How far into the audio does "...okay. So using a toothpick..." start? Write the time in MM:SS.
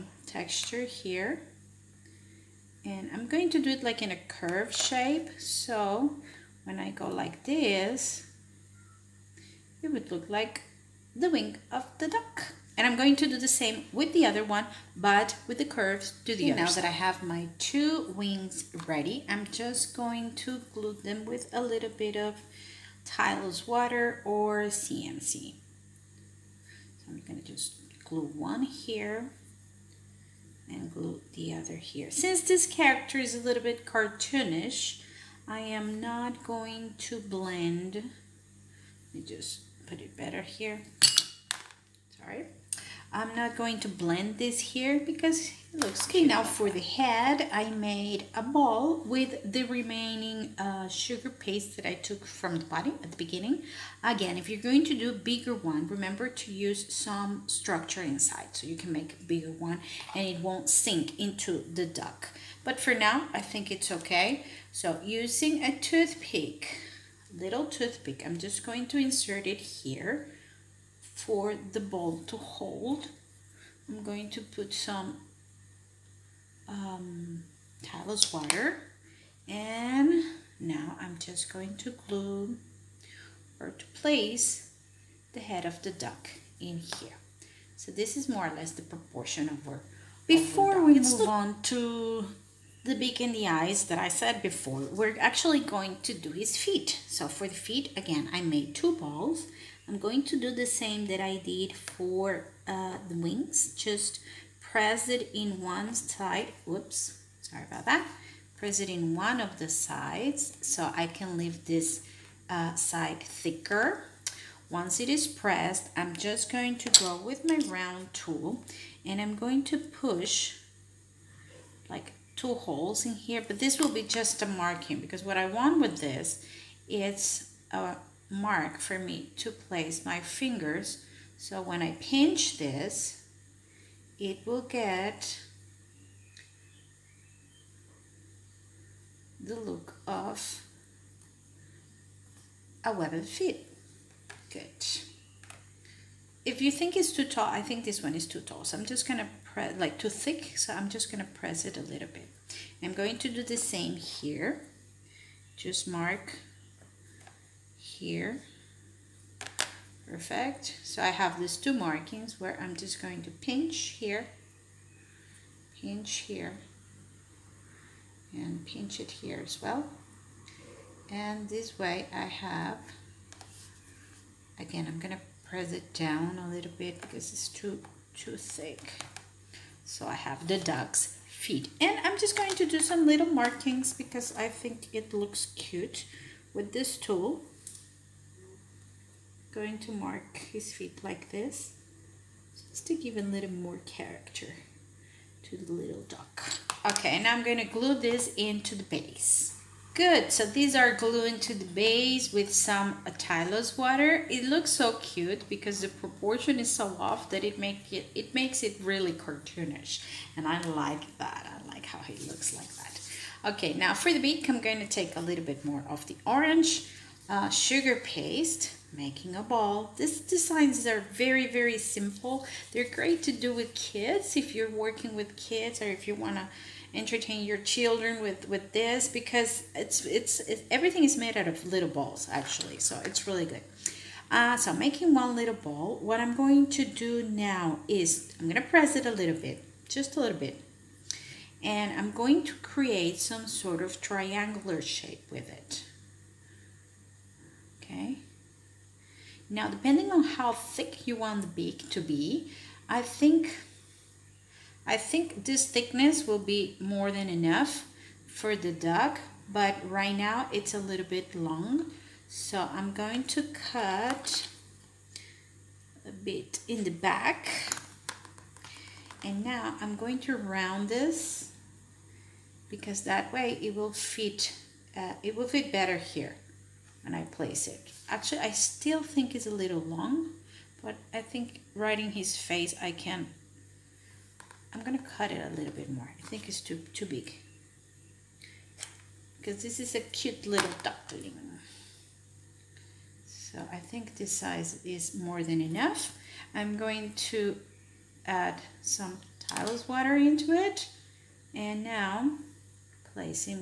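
01:03.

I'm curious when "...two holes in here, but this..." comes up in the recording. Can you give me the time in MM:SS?
02:02.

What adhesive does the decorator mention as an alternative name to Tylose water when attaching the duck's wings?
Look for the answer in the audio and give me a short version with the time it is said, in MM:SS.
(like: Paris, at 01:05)
CMC, at 00:24.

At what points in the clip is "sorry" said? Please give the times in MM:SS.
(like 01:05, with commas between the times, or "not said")
00:42, 01:47.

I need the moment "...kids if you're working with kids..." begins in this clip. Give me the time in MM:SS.
03:43.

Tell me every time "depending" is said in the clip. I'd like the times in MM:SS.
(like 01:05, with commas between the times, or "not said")
04:09.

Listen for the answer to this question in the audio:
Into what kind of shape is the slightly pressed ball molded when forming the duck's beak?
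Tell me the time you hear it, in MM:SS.
04:03.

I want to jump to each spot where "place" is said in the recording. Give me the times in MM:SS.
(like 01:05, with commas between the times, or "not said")
01:23, 02:09, 04:37.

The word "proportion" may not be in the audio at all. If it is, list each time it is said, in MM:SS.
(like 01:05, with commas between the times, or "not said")
01:28, 03:25.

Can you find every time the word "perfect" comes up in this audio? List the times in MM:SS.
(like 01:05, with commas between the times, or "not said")
02:40.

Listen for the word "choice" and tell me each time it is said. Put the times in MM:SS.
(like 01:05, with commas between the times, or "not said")
not said.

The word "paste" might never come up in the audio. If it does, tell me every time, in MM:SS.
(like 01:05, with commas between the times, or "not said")
00:51, 03:37.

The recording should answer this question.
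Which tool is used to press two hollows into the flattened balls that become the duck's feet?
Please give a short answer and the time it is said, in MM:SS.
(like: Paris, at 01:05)
round tool, at 01:57.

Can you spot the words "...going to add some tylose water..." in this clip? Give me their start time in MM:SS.
04:56.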